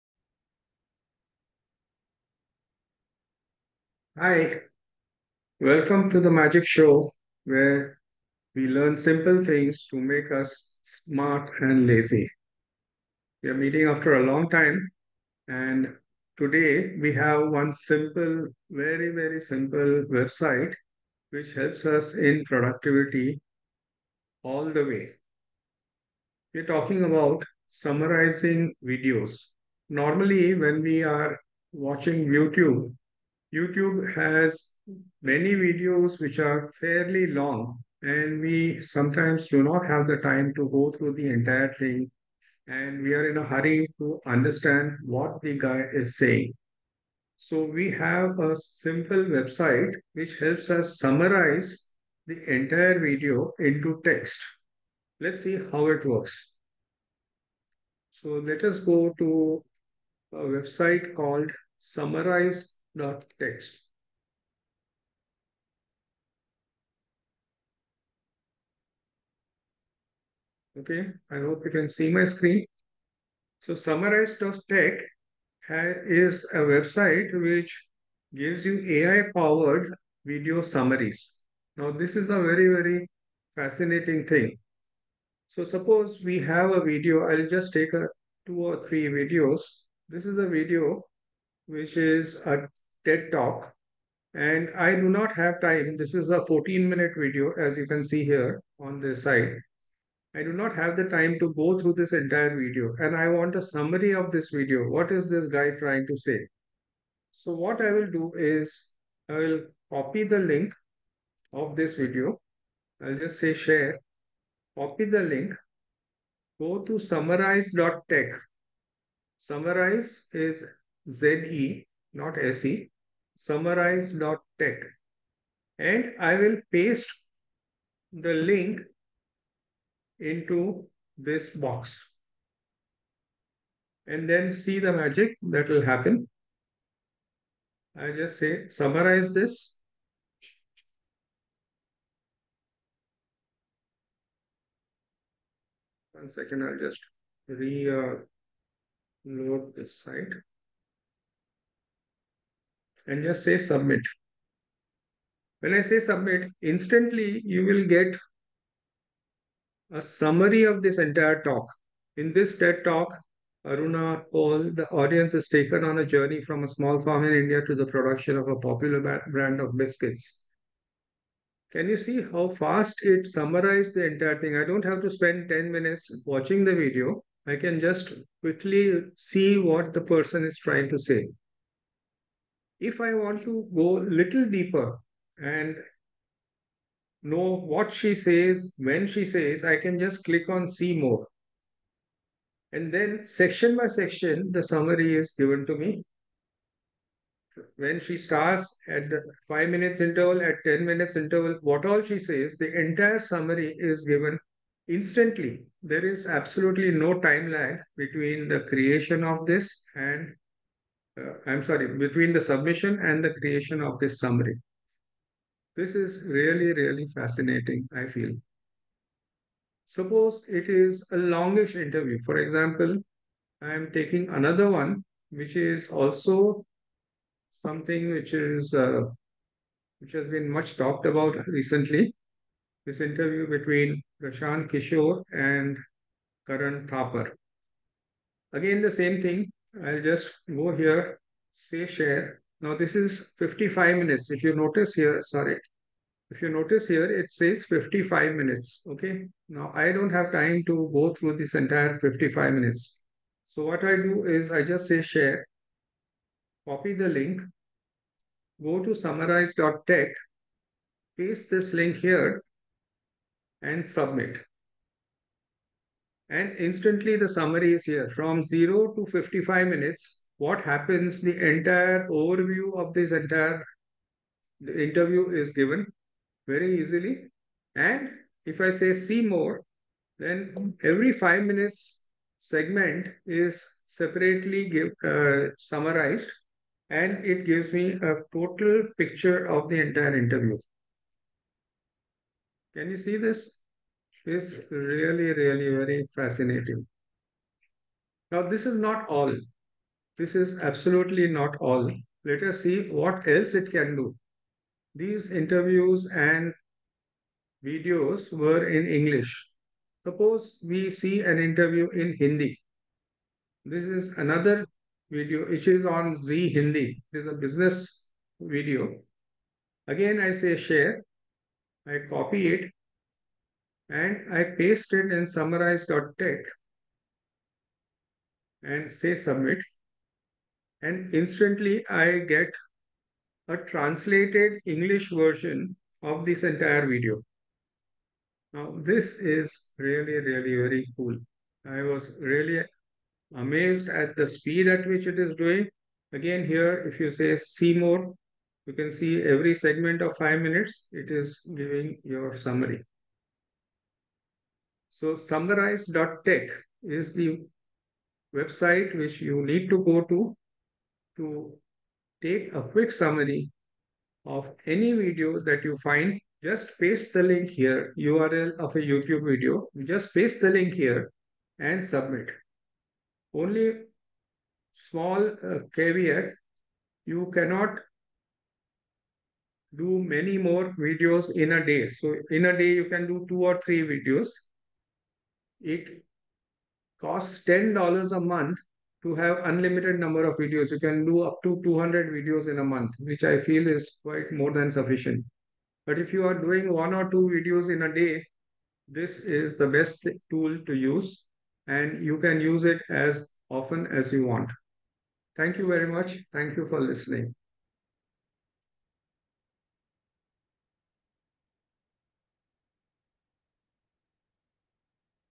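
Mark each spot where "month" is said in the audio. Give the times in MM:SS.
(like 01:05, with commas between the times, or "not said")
06:28, 06:32.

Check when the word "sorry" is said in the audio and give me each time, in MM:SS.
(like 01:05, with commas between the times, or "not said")
03:31, 04:05.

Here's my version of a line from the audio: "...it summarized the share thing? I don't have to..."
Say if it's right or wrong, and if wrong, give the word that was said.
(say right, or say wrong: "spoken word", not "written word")
wrong: "entire", not "share".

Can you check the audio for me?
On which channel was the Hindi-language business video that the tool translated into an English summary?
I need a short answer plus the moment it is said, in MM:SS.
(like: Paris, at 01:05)
Zee Hindi, at 05:16.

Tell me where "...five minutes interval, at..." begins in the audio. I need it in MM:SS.
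03:19.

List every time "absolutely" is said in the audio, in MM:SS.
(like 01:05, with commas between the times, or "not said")
03:26, 05:00.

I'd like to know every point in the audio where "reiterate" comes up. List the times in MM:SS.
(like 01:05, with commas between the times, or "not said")
not said.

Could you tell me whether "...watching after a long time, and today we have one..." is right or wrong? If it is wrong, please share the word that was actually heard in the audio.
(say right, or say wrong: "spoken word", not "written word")
wrong: "meeting", not "watching".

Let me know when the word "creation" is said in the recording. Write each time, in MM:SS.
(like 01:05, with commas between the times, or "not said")
03:28, 03:33.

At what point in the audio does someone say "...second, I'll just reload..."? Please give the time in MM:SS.
02:26.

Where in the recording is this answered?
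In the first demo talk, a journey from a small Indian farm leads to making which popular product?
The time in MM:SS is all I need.
02:49.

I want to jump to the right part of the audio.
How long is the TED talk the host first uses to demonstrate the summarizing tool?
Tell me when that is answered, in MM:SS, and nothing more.
01:36.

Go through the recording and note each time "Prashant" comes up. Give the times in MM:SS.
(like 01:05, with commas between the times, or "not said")
03:54.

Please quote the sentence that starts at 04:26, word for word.
And instantly the summary is here.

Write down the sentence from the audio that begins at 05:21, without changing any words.
I copy it and I paste it in summarize.tech and say submit.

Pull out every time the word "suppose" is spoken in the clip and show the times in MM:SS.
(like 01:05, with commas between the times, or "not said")
01:25, 03:39, 05:10.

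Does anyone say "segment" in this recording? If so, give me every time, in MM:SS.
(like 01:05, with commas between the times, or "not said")
04:42, 05:49.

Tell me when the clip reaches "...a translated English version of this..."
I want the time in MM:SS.
05:33.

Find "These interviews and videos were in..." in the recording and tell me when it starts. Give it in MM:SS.
05:04.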